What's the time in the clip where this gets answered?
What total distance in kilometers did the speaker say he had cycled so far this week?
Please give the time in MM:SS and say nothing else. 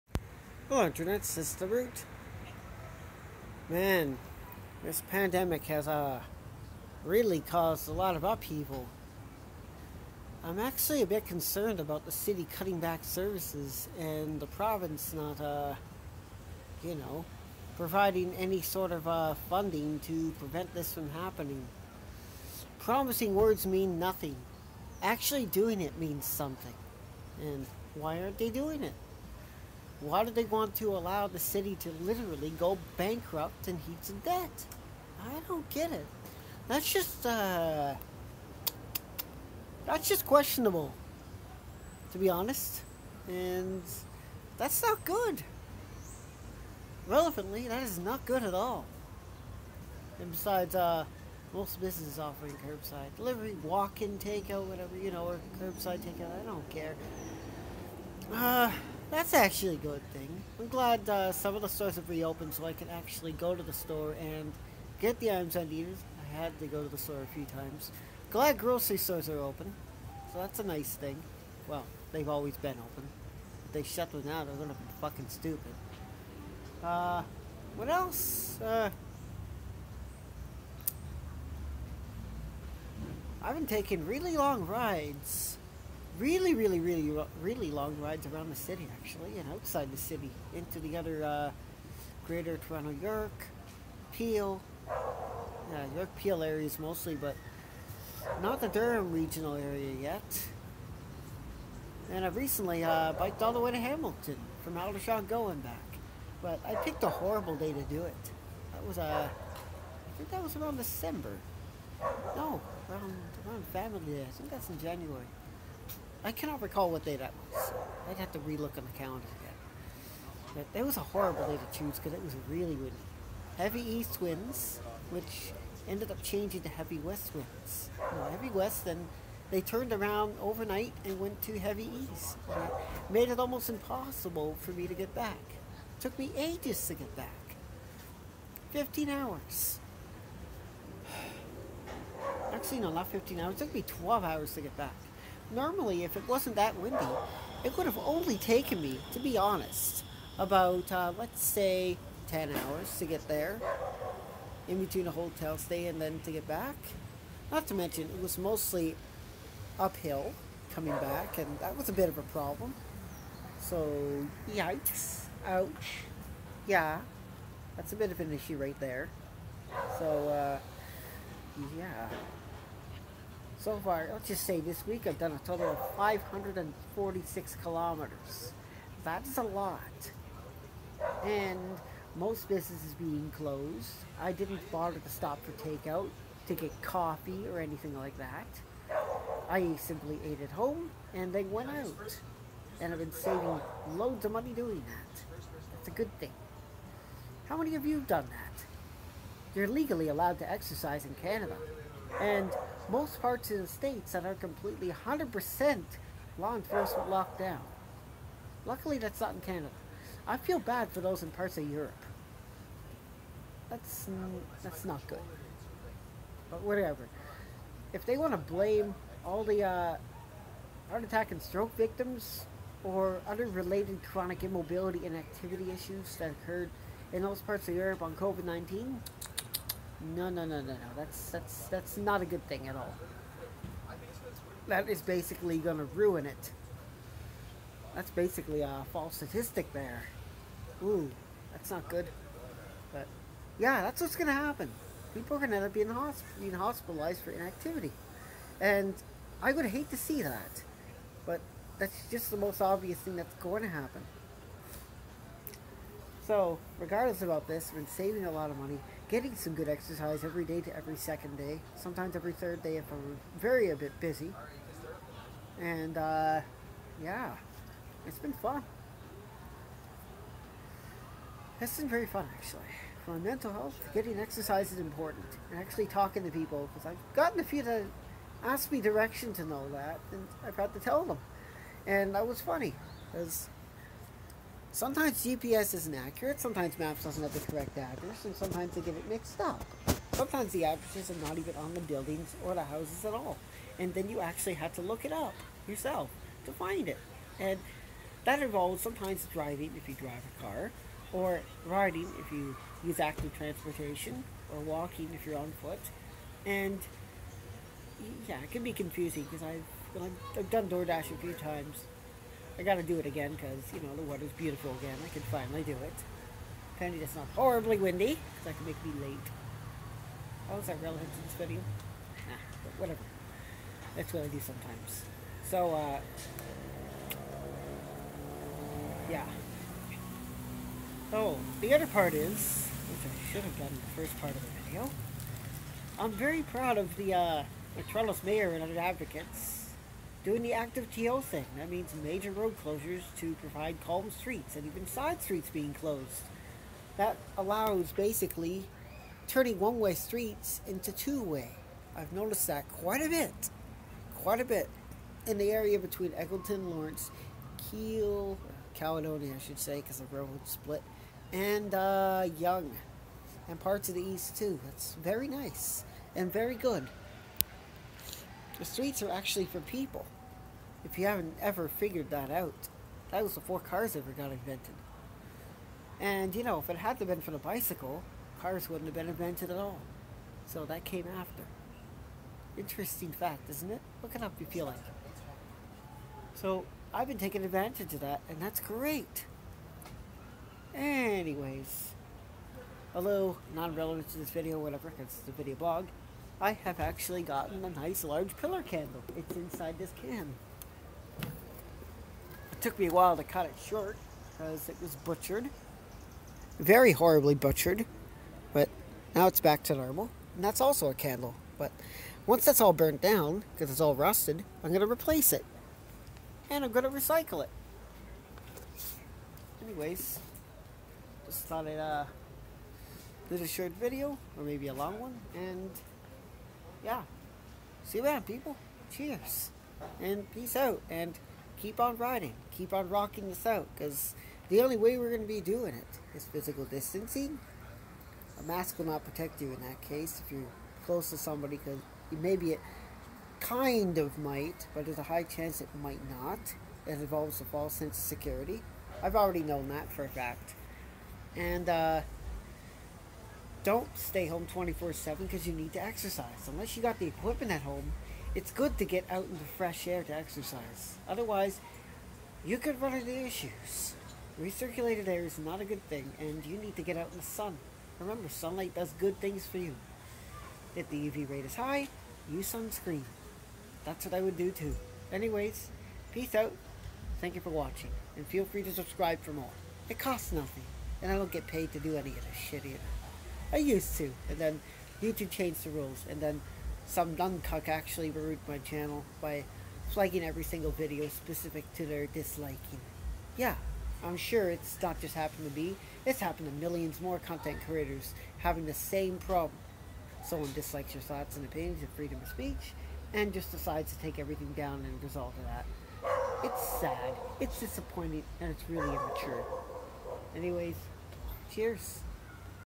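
02:55.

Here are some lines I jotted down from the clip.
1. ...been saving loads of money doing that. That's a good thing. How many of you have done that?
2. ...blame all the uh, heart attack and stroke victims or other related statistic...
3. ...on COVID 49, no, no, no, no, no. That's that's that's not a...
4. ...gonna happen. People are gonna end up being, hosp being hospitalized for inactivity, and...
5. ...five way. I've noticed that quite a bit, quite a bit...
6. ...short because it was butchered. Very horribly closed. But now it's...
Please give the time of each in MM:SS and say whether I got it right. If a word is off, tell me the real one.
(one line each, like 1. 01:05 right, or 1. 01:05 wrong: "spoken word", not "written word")
1. 03:12 right
2. 03:38 wrong: "chronic", not "statistic"
3. 03:48 wrong: "19", not "49"
4. 04:04 right
5. 05:50 wrong: "two", not "five"
6. 06:43 wrong: "butchered", not "closed".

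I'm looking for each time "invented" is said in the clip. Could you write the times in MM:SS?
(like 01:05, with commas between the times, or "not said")
06:14, 06:19.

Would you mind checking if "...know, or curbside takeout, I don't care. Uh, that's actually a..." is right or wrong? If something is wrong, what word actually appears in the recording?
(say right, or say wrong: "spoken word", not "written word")
right.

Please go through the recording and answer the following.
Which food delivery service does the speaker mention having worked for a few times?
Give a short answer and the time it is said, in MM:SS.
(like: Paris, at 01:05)
DoorDash, at 05:10.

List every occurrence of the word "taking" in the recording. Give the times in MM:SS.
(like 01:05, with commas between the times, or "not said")
01:23, 06:27.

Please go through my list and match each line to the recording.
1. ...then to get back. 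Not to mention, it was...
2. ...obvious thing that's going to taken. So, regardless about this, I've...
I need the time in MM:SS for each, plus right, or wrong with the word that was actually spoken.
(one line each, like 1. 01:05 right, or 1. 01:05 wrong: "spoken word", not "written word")
1. 02:36 right
2. 04:12 wrong: "happen", not "taken".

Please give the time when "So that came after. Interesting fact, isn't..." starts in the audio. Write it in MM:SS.
06:20.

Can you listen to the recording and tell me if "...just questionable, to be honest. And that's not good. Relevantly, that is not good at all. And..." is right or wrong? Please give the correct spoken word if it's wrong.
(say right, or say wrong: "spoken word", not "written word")
right.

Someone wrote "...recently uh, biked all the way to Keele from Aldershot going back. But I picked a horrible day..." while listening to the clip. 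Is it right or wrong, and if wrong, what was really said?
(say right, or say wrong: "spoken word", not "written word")
wrong: "Hamilton", not "Keele".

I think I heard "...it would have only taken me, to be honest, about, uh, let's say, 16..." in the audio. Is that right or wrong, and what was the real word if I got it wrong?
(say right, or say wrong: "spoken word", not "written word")
wrong: "10", not "16".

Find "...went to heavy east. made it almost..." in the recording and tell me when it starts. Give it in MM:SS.
02:11.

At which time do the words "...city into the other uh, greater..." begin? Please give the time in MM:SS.
01:29.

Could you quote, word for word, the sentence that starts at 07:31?
And, uh, don't stay home 24 7 because you need to exercise.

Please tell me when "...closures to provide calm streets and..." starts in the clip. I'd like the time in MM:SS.
05:42.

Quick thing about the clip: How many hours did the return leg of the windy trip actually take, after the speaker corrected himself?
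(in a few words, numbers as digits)
12.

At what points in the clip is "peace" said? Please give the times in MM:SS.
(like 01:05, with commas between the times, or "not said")
07:10, 07:56.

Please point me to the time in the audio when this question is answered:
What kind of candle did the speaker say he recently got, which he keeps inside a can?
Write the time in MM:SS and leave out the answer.
06:38.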